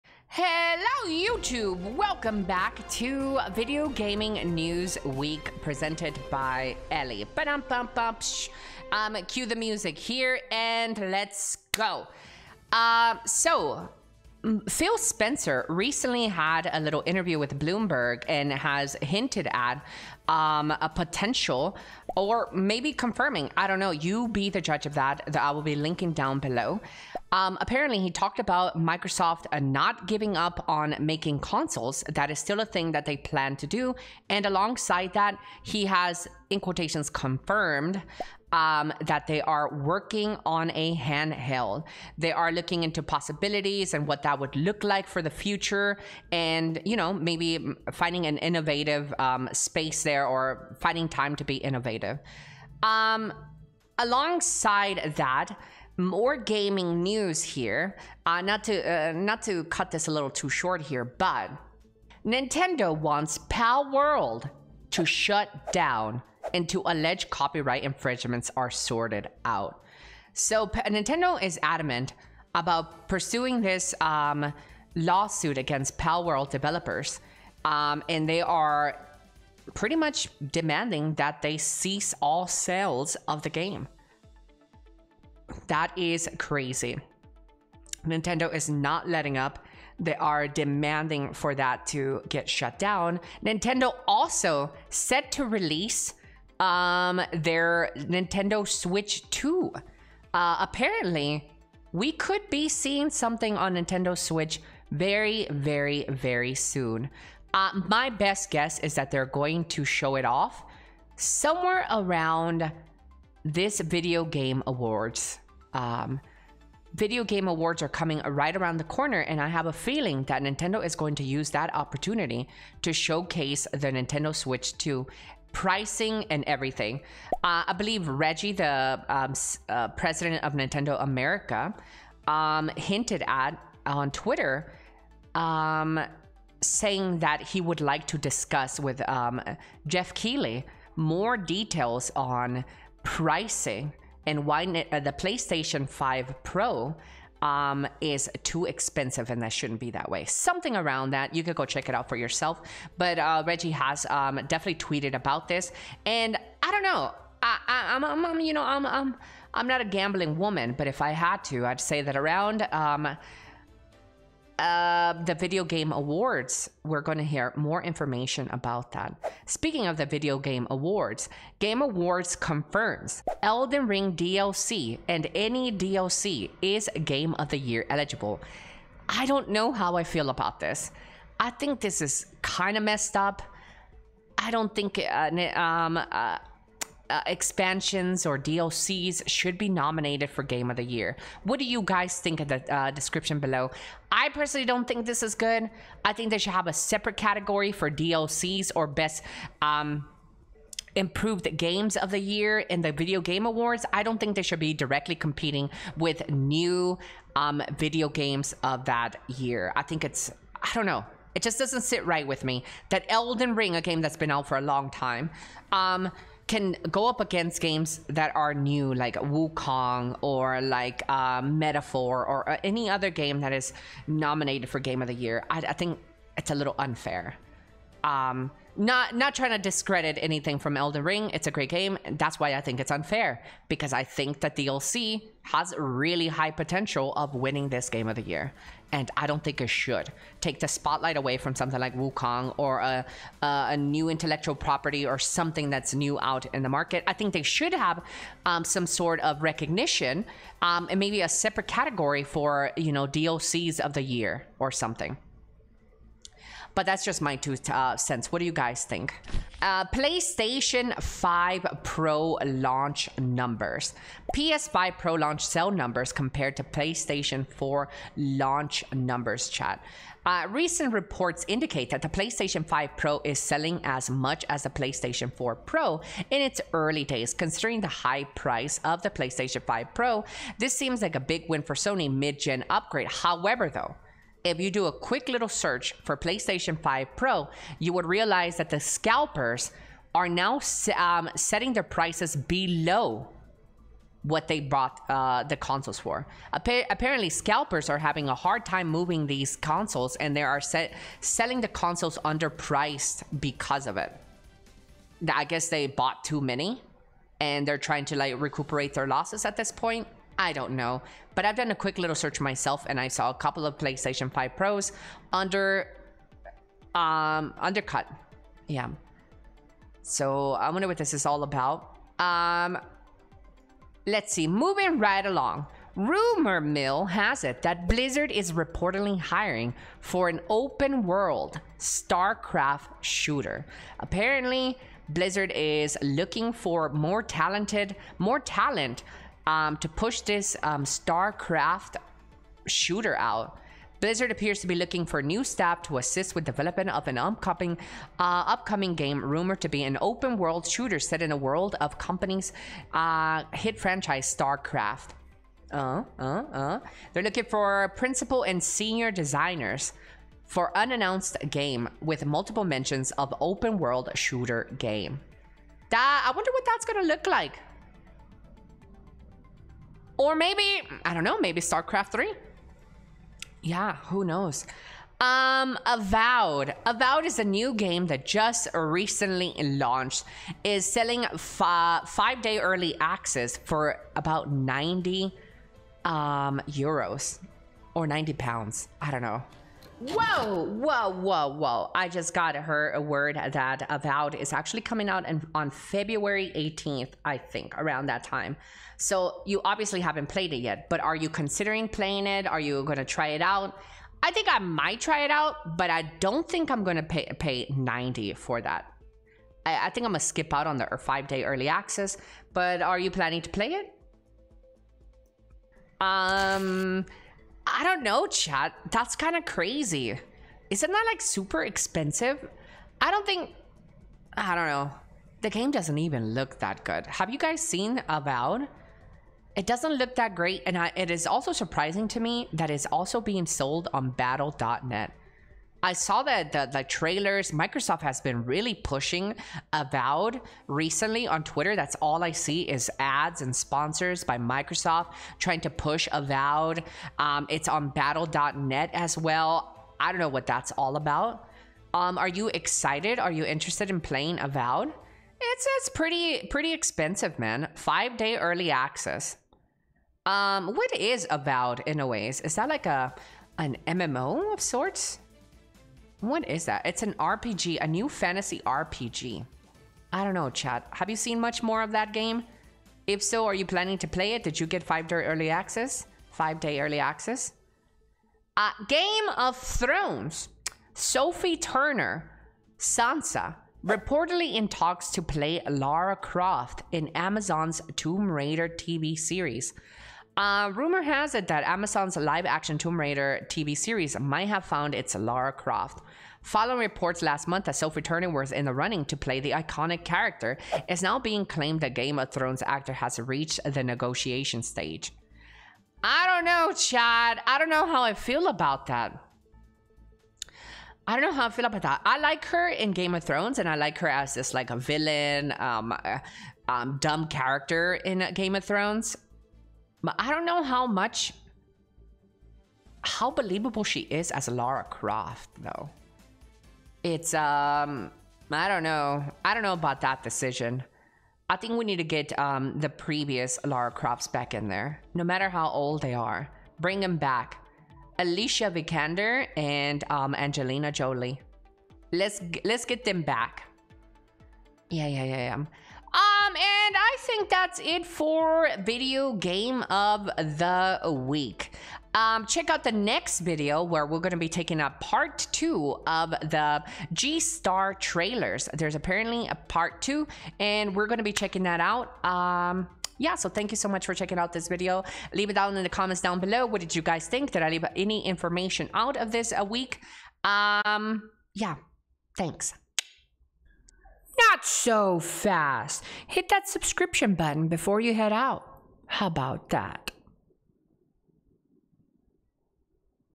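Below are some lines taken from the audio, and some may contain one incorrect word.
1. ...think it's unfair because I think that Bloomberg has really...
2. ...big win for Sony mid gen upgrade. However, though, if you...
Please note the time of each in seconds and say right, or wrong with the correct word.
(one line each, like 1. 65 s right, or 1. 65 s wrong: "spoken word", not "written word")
1. 232 s wrong: "DLC", not "Bloomberg"
2. 281 s right.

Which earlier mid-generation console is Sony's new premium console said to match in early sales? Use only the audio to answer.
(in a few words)
PlayStation 4 Pro.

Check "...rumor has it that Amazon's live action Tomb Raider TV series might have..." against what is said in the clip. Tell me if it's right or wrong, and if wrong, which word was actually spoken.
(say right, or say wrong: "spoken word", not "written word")
right.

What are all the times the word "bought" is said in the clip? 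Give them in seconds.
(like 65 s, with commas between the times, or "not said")
294 s, 305 s.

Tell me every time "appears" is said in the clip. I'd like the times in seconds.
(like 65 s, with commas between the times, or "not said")
344 s.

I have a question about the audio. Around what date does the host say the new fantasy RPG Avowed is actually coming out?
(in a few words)
February 18th.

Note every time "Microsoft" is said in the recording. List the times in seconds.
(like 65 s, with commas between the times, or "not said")
28 s, 437 s, 444 s.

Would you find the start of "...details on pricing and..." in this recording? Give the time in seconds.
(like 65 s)
141 s.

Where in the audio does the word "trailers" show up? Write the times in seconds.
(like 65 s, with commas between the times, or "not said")
436 s, 557 s.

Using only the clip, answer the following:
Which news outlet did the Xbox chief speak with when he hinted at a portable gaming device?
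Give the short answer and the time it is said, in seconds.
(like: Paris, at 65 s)
Bloomberg, at 17 s.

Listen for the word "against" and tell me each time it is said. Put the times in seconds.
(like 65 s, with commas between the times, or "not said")
75 s, 217 s.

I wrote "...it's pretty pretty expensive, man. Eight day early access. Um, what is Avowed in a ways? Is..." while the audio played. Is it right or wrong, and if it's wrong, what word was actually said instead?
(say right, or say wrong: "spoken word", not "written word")
wrong: "Five", not "Eight".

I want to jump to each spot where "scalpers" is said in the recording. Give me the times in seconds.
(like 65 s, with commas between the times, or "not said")
288 s, 297 s.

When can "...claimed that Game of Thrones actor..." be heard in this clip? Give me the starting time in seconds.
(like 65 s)
501 s.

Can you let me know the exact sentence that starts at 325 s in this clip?
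Rumor mill has it that Blizzard is reportedly hiring for an open world StarCraft shooter.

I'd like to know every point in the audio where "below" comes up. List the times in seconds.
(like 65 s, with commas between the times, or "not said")
26 s, 193 s, 292 s, 566 s.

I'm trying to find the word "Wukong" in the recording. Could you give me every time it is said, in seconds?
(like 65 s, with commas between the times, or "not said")
219 s, 241 s.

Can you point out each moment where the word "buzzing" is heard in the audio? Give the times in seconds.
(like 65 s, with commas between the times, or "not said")
not said.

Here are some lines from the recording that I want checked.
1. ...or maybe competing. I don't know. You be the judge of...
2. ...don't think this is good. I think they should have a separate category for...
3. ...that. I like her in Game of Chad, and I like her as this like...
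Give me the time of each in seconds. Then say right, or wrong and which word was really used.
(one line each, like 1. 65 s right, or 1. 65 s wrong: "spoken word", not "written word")
1. 22 s wrong: "confirming", not "competing"
2. 194 s right
3. 511 s wrong: "Thrones", not "Chad".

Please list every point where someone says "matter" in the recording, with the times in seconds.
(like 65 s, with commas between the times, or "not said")
535 s.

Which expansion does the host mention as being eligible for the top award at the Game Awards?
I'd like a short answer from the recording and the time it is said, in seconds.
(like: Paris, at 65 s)
Elden Ring DLC, at 173 s.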